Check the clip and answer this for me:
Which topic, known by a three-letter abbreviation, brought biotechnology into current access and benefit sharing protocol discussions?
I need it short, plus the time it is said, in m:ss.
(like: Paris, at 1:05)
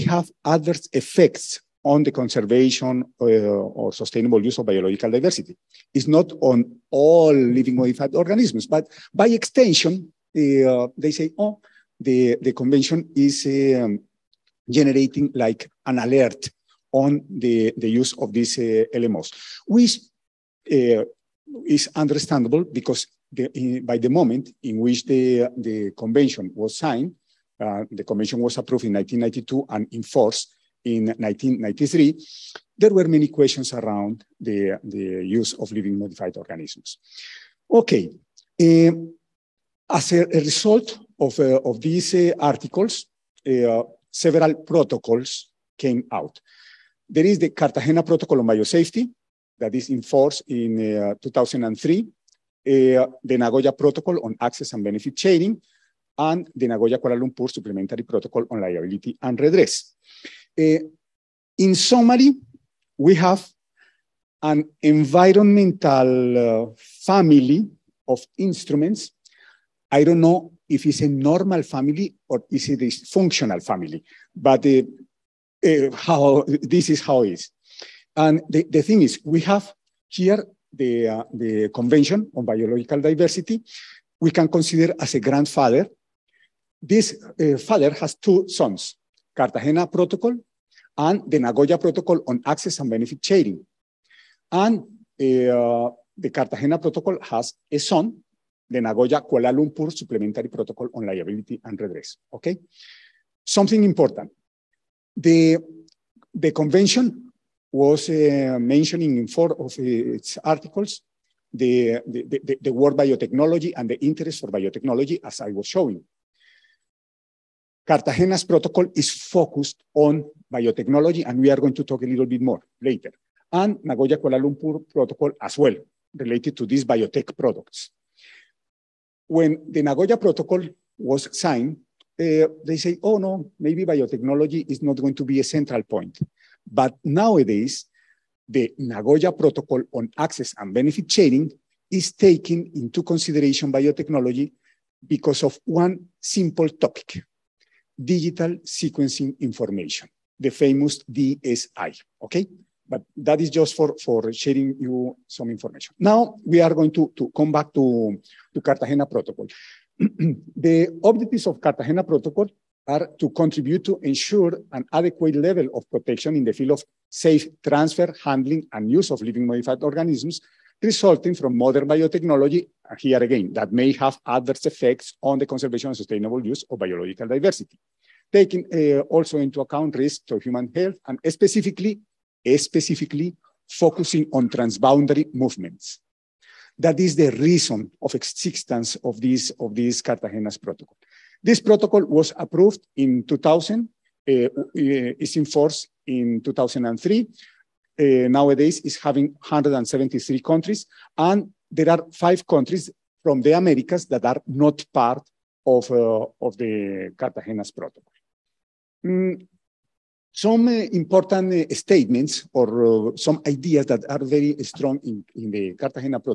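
Digital sequencing information, at 2:27.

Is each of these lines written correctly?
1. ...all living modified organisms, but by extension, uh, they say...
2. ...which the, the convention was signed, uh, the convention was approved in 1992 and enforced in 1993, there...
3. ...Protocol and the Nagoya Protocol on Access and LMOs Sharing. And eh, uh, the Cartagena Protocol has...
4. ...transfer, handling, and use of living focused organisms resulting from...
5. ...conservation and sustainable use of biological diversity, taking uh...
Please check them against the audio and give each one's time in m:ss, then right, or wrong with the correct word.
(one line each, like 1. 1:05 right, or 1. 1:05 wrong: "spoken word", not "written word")
1. 0:06 right
2. 0:24 right
3. 1:29 wrong: "Benefit", not "LMOs"
4. 2:47 wrong: "modified", not "focused"
5. 2:55 right.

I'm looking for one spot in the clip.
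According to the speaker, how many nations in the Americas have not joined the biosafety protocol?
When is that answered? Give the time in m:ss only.
3:22.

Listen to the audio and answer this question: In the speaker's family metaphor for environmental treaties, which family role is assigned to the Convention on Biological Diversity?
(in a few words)
Grandfather.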